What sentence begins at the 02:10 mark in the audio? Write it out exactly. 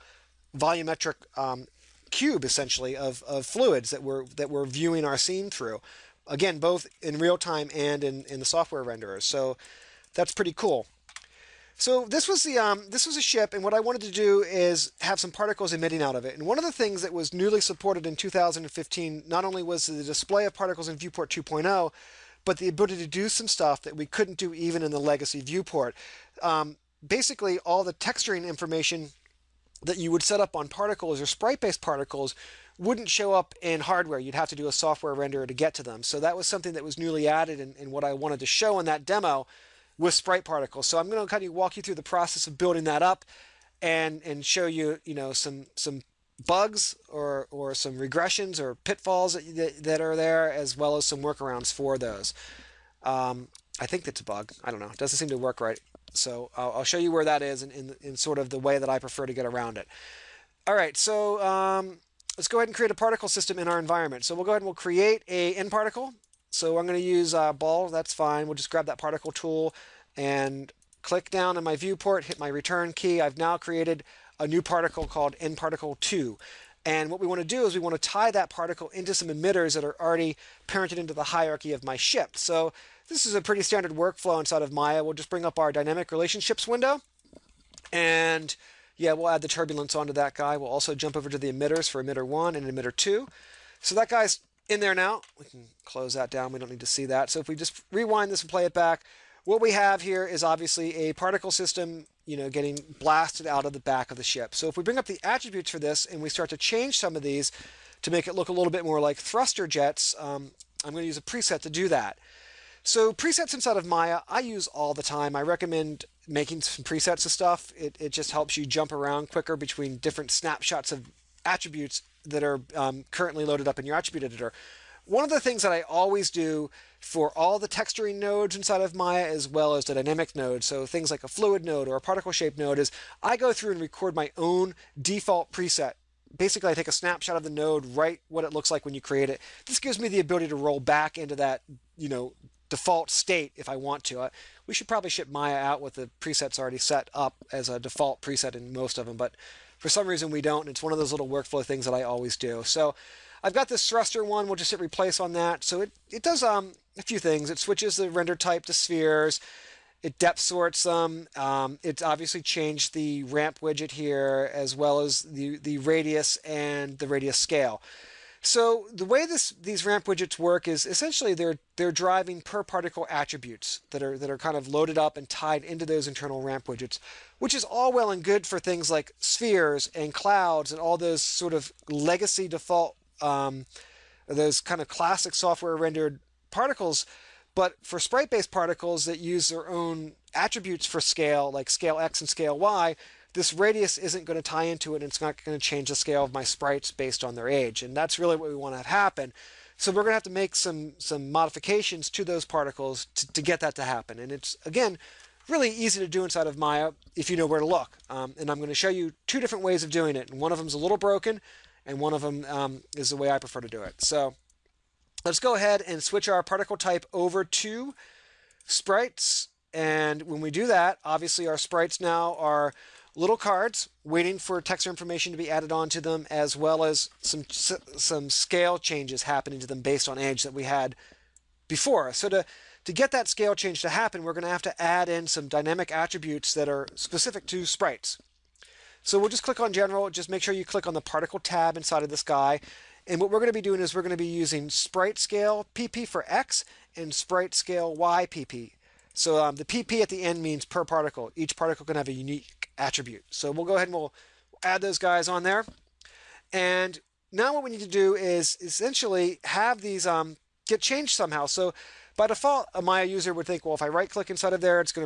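So things like a fluid node or a particle shape node is I go through and record my own default preset.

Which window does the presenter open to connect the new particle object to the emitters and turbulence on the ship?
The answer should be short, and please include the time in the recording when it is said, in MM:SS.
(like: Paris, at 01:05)
Dynamic relationships window, at 01:25.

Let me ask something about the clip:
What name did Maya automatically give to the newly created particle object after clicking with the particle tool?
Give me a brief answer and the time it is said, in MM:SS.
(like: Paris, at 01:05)
nParticle 2, at 01:15.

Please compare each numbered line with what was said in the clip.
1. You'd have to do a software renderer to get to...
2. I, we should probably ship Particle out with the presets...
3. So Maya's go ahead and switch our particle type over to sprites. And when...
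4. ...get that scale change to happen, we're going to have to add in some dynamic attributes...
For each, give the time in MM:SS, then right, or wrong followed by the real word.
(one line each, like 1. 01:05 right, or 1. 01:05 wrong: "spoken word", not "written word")
1. 00:34 right
2. 02:24 wrong: "Maya", not "Particle"
3. 03:34 wrong: "Let", not "Maya"
4. 03:52 right.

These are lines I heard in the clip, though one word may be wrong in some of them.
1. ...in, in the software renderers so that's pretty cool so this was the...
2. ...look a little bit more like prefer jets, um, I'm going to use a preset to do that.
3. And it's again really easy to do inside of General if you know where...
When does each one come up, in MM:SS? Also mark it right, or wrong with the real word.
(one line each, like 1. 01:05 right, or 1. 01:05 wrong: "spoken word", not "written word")
1. 00:08 right
2. 01:48 wrong: "thruster", not "prefer"
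3. 03:24 wrong: "Maya", not "General".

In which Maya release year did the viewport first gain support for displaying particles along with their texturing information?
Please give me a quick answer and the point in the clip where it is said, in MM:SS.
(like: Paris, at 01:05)
2015, at 00:18.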